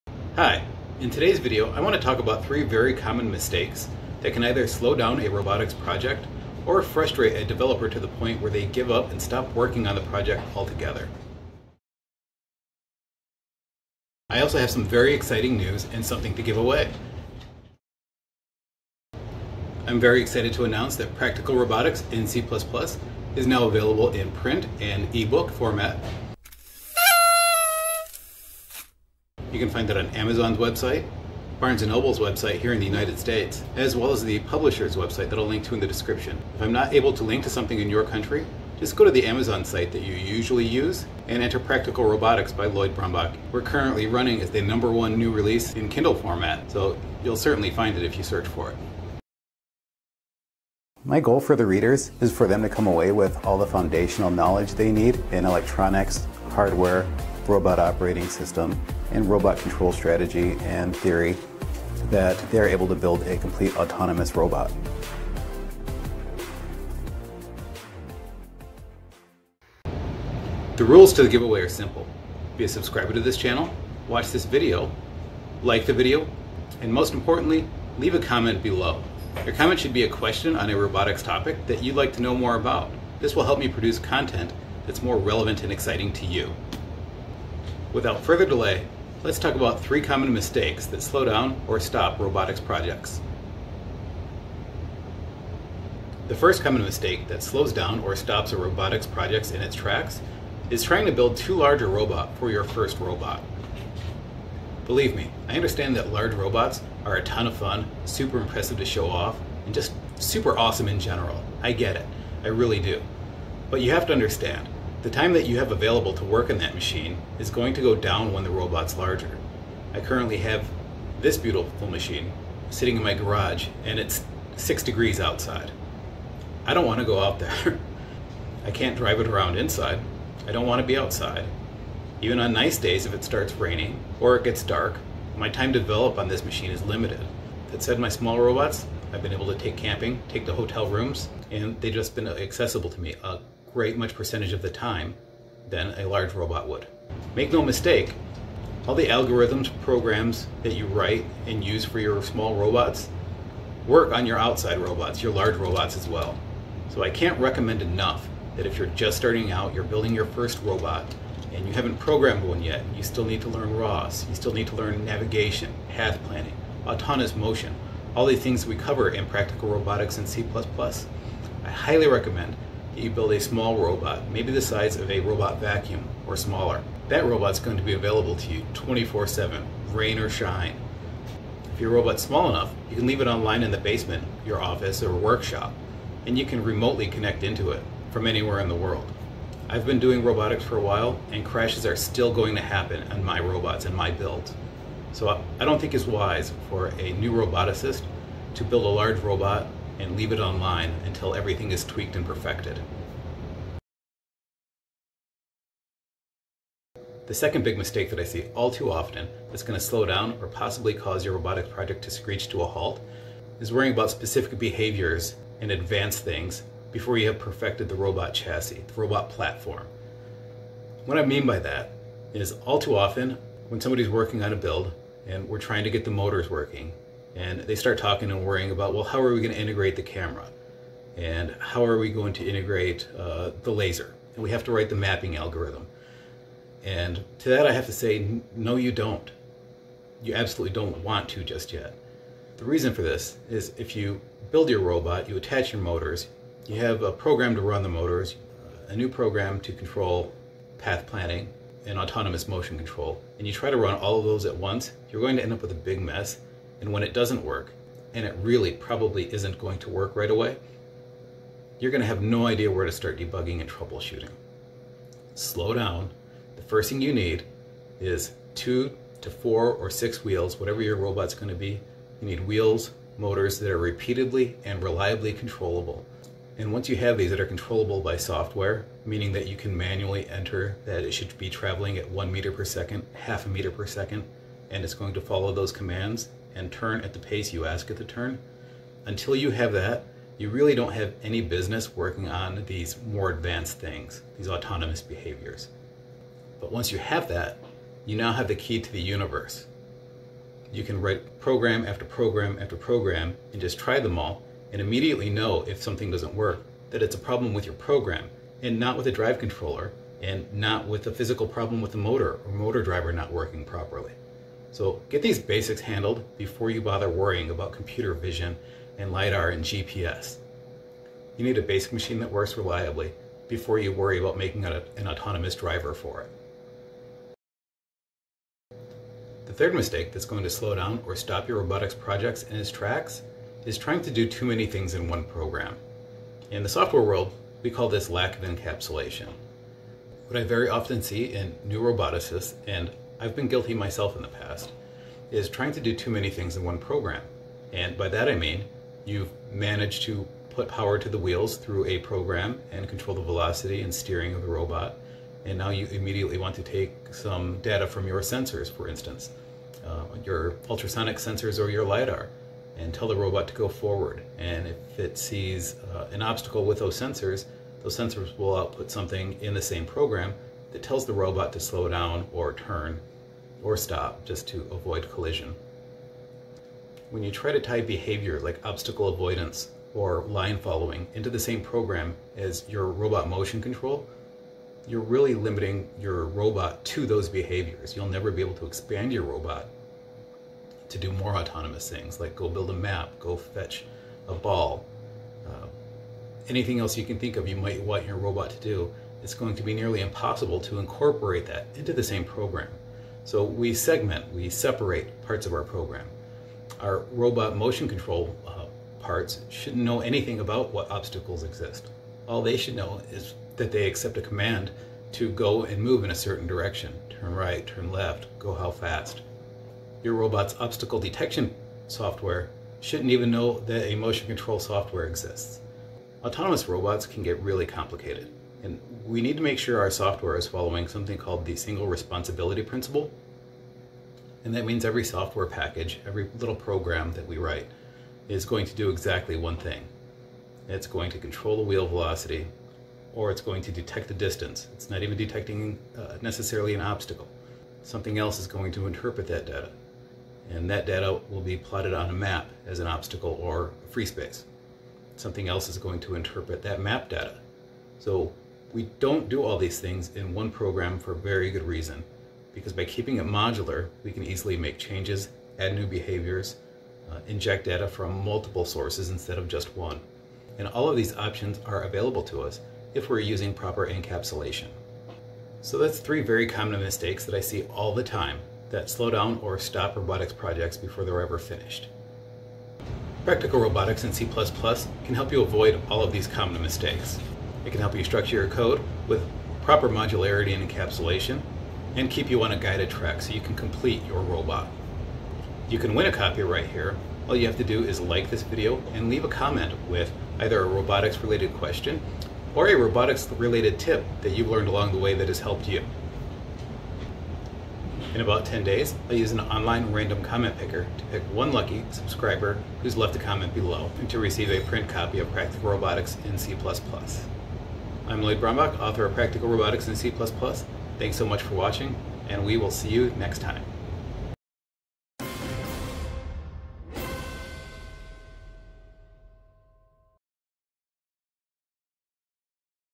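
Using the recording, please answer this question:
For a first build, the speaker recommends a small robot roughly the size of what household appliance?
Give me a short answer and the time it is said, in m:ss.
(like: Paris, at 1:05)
robot vacuum, at 2:55.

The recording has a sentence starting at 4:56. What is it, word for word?
But once you have that, you now have the key to the universe.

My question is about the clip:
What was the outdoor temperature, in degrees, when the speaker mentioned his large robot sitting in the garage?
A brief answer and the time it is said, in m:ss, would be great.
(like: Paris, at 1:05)
6, at 2:04.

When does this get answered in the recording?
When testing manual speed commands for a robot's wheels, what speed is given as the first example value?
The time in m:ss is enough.
4:42.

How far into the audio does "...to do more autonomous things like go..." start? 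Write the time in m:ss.
6:30.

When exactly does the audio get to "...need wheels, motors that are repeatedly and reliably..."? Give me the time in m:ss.
4:32.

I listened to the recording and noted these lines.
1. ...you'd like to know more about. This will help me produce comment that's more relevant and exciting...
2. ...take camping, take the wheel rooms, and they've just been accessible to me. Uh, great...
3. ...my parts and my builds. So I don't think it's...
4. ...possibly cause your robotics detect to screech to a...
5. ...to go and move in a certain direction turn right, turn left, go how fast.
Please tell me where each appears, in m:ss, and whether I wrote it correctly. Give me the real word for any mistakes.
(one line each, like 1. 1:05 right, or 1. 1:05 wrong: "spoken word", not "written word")
1. 1:21 wrong: "content", not "comment"
2. 2:19 wrong: "hotel", not "wheel"
3. 3:13 wrong: "robots", not "parts"
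4. 3:30 wrong: "project", not "detect"
5. 6:55 right.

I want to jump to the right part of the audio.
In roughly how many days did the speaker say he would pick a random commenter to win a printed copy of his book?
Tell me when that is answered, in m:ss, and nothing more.
8:28.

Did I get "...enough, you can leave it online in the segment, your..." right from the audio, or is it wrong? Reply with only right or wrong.
wrong.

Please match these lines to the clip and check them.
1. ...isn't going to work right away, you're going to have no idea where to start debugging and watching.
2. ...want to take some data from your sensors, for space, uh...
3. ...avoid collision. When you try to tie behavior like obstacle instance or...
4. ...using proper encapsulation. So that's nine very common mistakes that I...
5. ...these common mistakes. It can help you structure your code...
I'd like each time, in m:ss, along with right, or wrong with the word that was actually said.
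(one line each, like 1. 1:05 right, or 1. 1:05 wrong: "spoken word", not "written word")
1. 4:19 wrong: "troubleshooting", not "watching"
2. 5:56 wrong: "instance", not "space"
3. 6:14 wrong: "avoidance", not "instance"
4. 7:53 wrong: "three", not "nine"
5. 8:06 right.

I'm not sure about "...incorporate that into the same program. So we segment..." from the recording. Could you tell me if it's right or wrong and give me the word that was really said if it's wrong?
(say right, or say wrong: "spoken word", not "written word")
right.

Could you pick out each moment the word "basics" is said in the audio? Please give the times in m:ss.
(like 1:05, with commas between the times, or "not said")
5:15, 5:21.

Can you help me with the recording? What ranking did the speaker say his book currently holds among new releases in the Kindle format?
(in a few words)
number one.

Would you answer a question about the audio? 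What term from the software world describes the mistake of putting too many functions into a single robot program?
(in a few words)
lack of encapsulation.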